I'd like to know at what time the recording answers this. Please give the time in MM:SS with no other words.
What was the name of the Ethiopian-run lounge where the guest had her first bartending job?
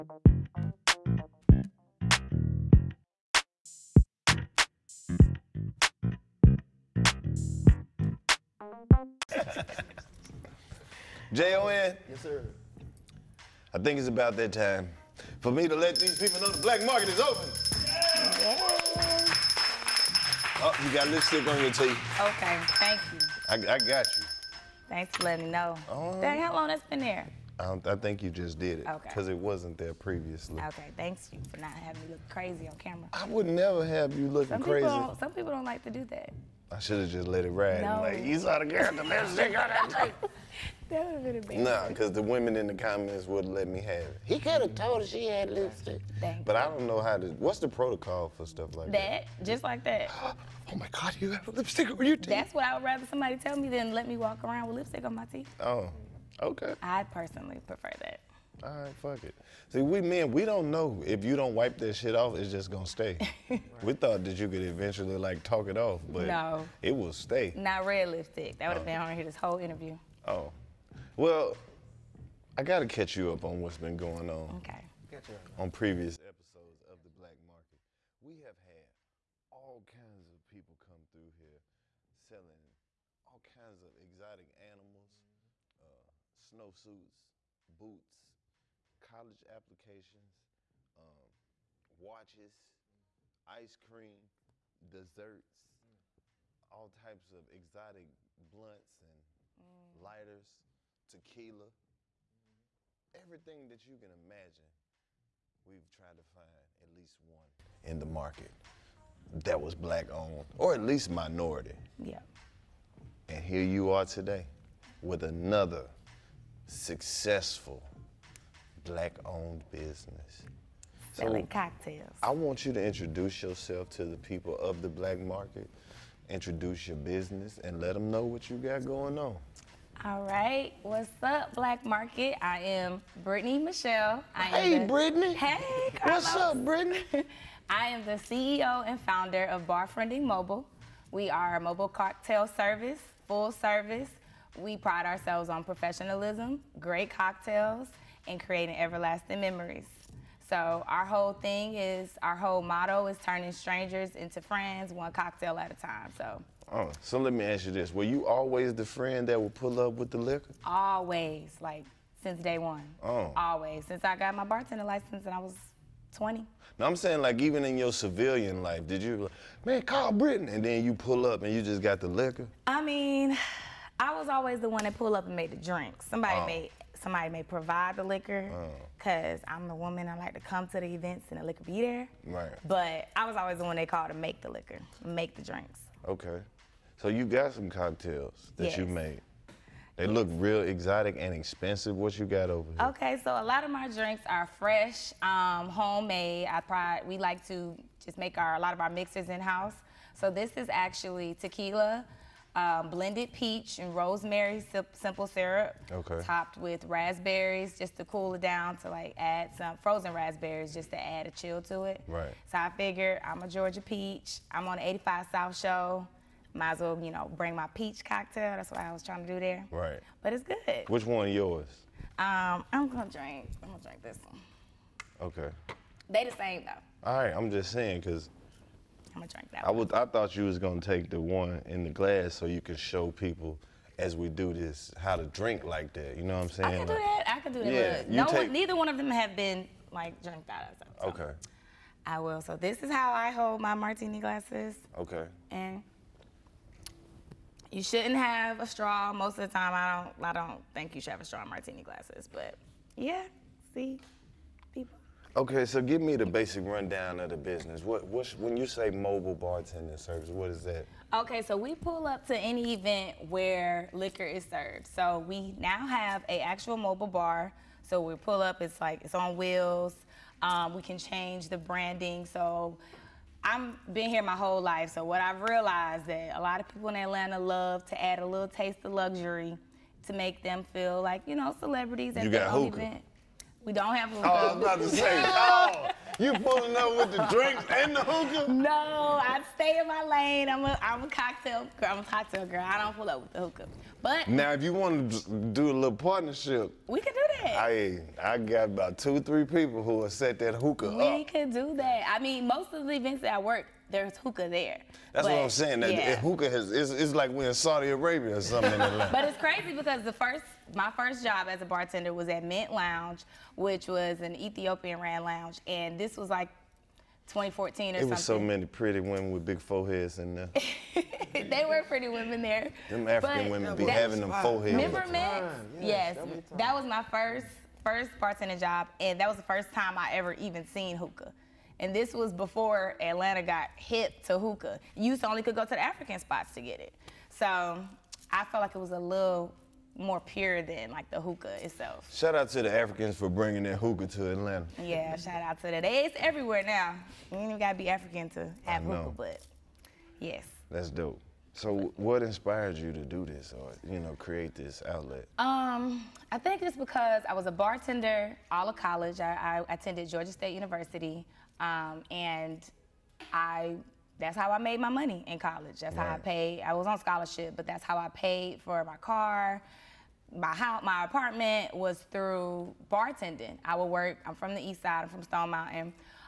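05:12.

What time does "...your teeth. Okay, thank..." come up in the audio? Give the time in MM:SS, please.
00:21.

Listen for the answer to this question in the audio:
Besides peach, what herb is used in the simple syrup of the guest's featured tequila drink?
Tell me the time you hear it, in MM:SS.
03:23.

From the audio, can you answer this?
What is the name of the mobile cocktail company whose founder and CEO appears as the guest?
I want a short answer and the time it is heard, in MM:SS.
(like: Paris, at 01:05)
Barfriending Mobile, at 02:19.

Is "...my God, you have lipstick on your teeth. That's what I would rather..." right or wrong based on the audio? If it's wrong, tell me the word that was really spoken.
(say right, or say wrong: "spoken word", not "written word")
right.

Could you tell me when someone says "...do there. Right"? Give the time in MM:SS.
03:39.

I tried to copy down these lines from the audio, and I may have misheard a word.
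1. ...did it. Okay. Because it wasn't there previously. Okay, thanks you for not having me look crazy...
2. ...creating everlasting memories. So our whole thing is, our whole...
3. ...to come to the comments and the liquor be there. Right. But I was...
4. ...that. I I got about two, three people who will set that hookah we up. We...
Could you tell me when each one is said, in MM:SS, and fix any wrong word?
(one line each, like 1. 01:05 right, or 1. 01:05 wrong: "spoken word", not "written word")
1. 00:28 right
2. 02:28 right
3. 03:00 wrong: "events", not "comments"
4. 04:57 right.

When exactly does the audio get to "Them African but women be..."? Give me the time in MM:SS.
05:22.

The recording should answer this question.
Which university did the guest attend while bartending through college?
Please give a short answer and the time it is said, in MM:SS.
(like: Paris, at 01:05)
Georgia State University, at 06:00.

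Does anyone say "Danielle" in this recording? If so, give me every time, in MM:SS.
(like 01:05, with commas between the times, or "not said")
not said.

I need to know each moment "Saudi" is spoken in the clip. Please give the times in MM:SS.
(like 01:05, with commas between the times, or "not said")
05:07.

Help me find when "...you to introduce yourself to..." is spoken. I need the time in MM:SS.
02:02.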